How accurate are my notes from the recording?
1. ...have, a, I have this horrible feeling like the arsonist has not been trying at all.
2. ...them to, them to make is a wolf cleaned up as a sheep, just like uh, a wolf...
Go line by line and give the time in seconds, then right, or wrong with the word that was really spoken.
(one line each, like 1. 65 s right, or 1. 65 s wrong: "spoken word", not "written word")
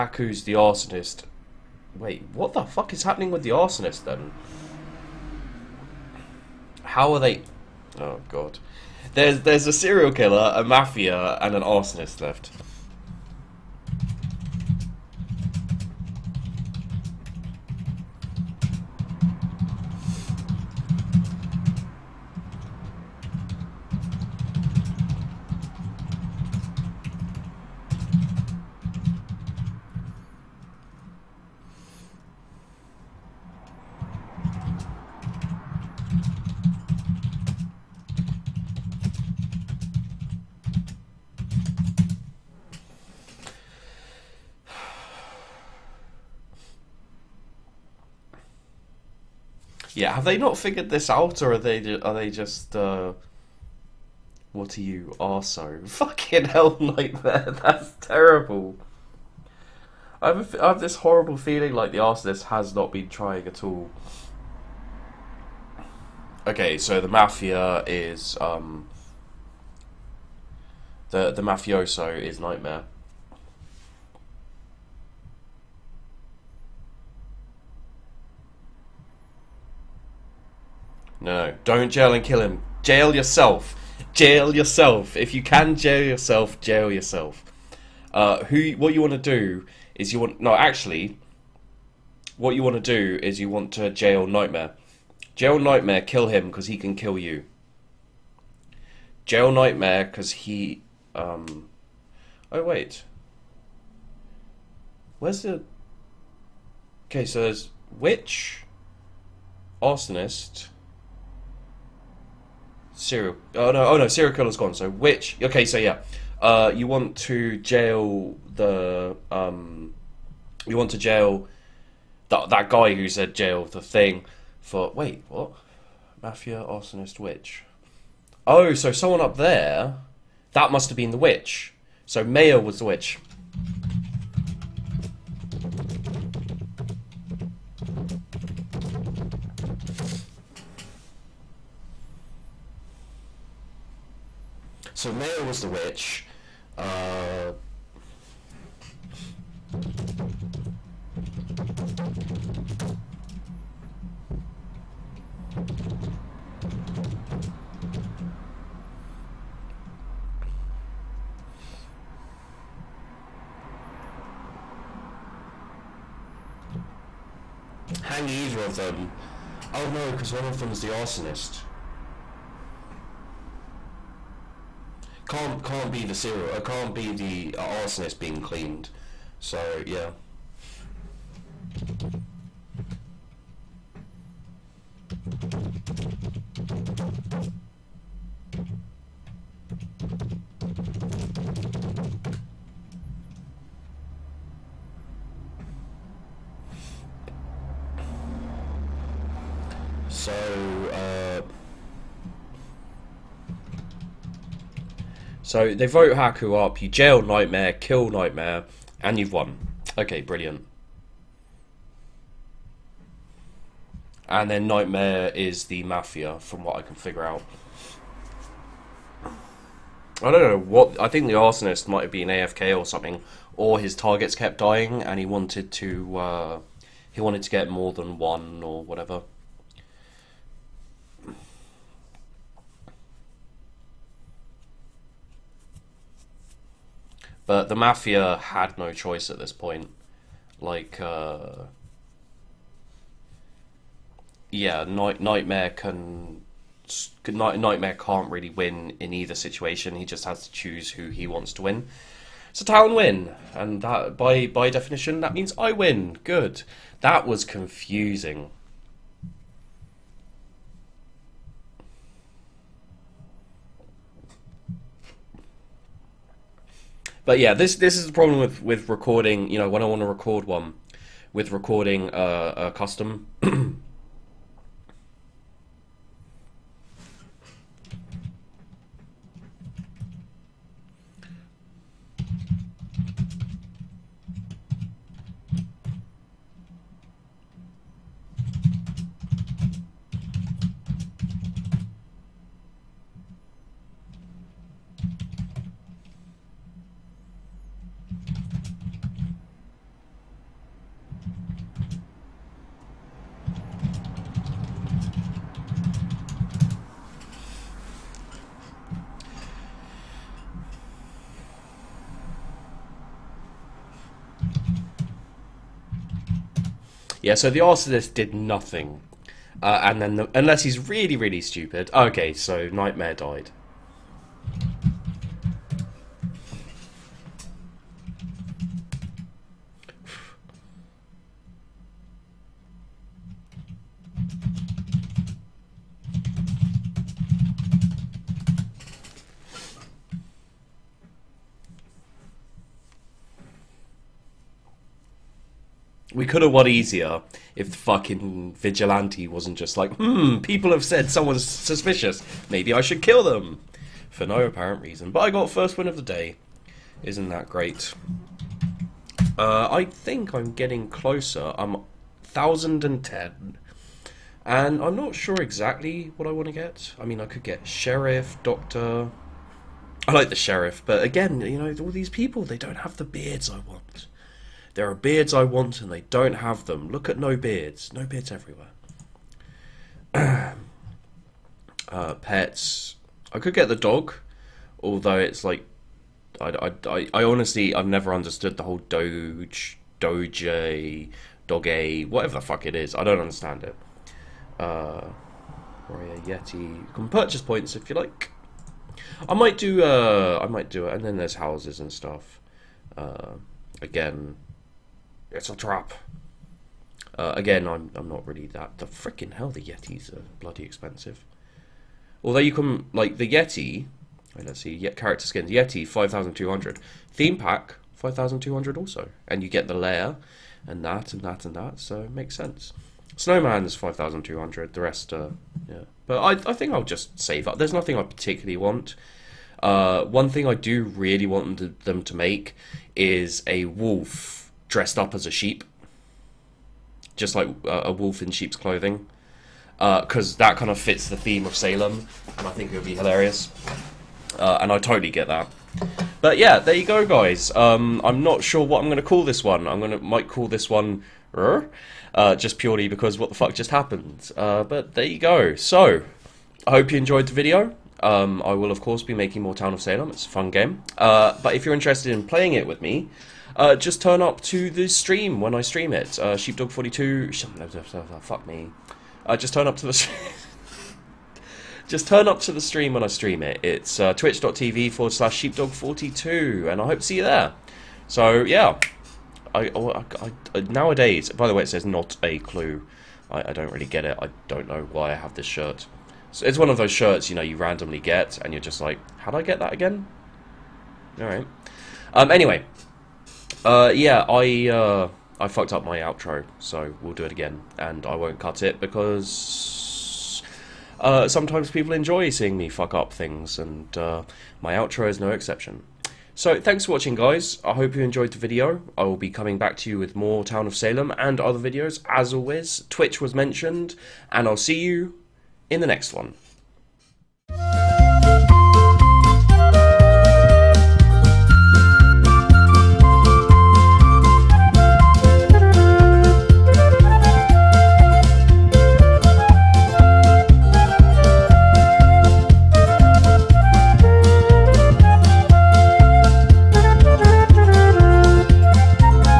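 1. 60 s right
2. 431 s wrong: "dressed", not "cleaned".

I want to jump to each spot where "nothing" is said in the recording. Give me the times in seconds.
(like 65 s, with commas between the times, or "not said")
318 s, 427 s.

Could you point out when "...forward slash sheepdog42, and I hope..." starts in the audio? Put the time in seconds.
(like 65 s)
474 s.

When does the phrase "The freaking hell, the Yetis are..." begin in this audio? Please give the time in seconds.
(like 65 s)
408 s.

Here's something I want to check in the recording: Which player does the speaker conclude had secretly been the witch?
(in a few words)
Mayo.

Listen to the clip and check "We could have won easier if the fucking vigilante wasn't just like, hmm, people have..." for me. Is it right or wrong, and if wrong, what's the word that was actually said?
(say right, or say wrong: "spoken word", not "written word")
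right.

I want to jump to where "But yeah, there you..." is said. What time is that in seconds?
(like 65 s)
446 s.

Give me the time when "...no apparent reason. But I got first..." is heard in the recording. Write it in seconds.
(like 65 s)
354 s.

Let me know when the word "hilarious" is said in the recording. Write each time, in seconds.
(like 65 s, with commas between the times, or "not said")
442 s.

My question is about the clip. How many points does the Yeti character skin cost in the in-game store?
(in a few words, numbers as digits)
5,200.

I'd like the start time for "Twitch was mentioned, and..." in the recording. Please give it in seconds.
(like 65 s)
512 s.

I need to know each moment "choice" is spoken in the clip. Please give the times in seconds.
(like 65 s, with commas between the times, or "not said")
238 s.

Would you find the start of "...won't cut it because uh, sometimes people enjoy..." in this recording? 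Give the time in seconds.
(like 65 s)
498 s.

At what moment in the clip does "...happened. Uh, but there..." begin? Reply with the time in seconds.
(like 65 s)
453 s.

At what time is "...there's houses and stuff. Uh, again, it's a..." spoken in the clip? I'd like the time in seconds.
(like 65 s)
401 s.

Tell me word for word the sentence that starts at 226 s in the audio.
Uh, he wanted to get more than one or whatever.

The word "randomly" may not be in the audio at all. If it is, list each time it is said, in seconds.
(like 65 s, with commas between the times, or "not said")
487 s.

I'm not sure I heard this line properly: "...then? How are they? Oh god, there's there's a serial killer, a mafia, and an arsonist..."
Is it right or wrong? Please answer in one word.
right.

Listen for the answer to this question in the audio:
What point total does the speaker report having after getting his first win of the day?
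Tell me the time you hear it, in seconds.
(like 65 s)
362 s.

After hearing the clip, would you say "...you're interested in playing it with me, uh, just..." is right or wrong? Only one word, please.
right.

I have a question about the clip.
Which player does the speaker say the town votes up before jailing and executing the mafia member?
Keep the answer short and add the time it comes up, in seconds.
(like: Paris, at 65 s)
Haku, at 206 s.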